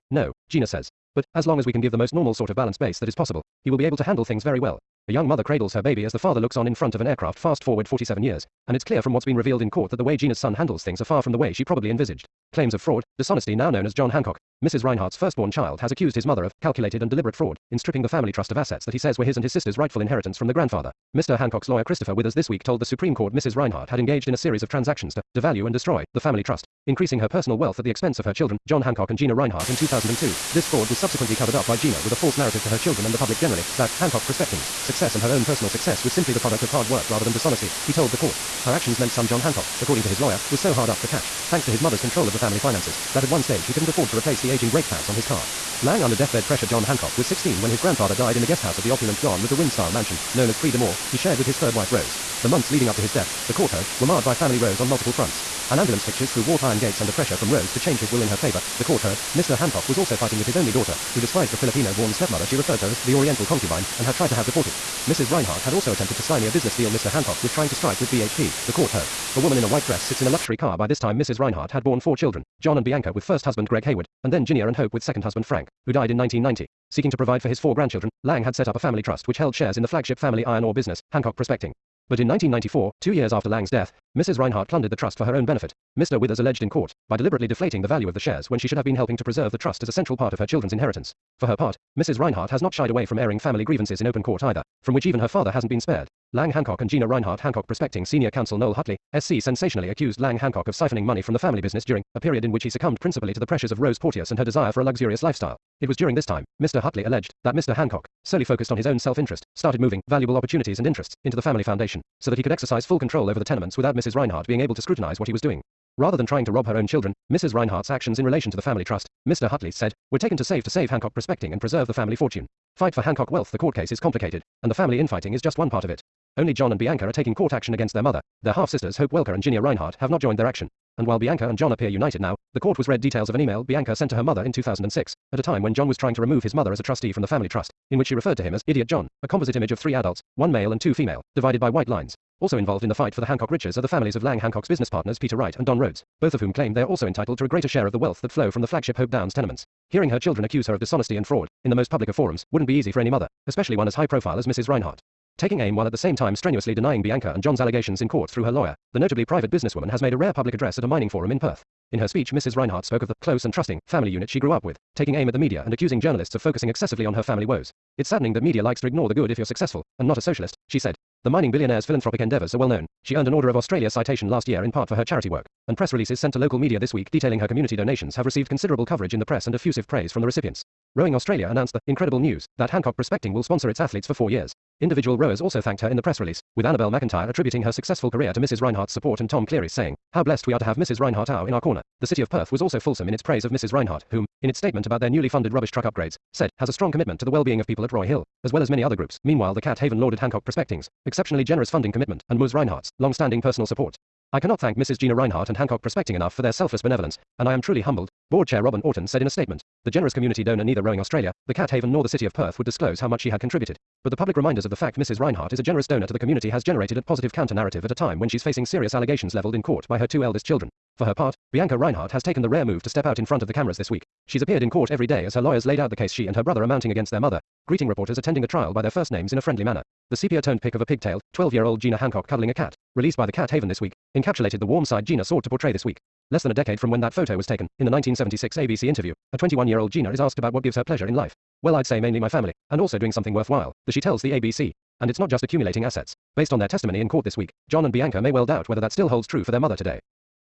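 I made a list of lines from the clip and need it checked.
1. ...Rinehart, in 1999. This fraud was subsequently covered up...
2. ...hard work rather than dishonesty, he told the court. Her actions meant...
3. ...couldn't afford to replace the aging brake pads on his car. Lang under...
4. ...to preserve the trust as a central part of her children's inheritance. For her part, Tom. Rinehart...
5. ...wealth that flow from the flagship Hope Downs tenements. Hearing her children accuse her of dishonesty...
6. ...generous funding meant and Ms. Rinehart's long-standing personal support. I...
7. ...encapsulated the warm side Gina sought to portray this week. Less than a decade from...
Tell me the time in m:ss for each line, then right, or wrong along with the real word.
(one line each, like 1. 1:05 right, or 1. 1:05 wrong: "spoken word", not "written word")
1. 0:29 wrong: "2002", not "1999"
2. 0:36 right
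3. 0:43 right
4. 1:29 wrong: "Mrs", not "Tom"
5. 2:27 right
6. 3:21 wrong: "commitment", not "meant"
7. 3:54 right.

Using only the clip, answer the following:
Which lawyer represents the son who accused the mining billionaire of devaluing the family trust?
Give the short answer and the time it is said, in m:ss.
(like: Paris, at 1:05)
Christopher Withers, at 0:21.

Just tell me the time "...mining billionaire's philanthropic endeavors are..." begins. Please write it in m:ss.
2:51.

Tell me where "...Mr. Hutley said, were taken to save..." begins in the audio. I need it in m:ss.
1:59.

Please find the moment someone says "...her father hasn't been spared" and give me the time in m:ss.
1:35.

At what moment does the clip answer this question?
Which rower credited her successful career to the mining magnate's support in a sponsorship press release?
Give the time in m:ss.
3:06.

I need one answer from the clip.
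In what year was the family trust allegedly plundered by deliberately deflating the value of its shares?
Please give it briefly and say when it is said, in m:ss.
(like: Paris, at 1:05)
1994, at 1:22.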